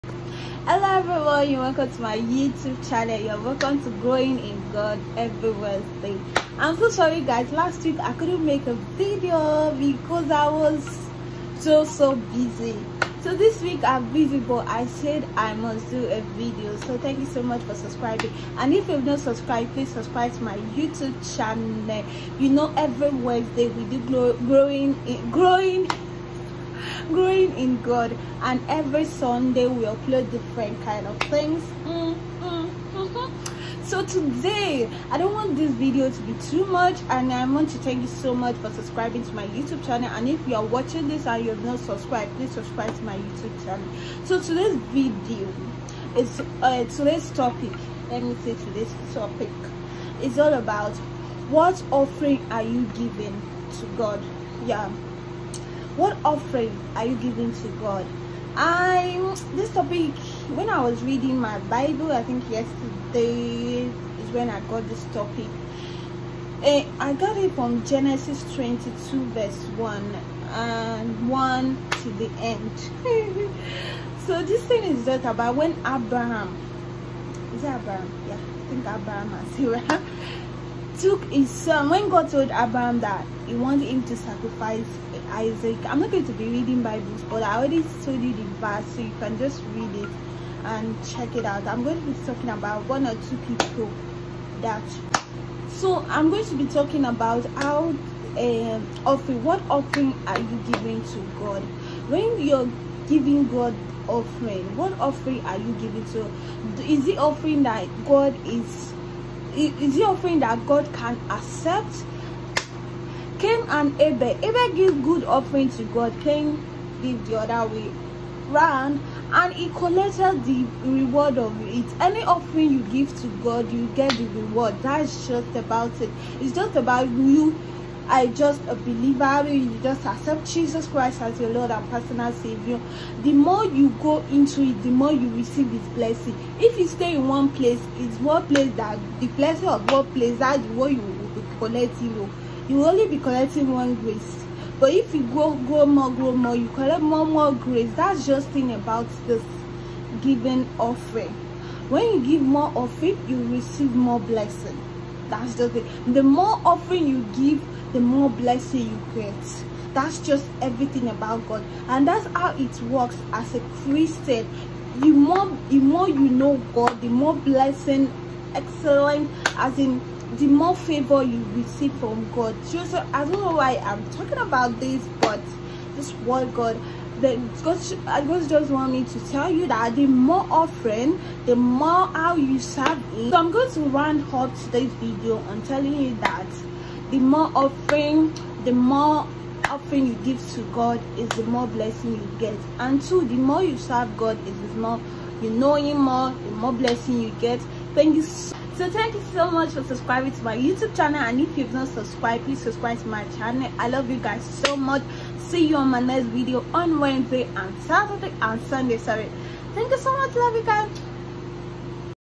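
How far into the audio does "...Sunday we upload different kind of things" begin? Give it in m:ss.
0:29.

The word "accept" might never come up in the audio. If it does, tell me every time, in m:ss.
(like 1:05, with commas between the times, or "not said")
1:51, 2:10.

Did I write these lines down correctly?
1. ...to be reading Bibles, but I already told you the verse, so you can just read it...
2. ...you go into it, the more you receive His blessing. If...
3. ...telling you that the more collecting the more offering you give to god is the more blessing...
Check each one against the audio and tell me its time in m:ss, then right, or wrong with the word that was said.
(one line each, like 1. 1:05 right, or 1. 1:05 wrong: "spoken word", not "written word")
1. 1:26 right
2. 2:13 right
3. 3:05 wrong: "offering", not "collecting".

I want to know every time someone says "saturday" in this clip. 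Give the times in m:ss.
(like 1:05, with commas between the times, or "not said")
3:27.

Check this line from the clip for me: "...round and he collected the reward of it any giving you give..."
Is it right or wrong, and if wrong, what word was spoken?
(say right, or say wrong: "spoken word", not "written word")
wrong: "offering", not "giving".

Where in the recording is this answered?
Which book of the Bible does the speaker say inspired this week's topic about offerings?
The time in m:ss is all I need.
1:07.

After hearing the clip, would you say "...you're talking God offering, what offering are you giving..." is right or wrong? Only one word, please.
wrong.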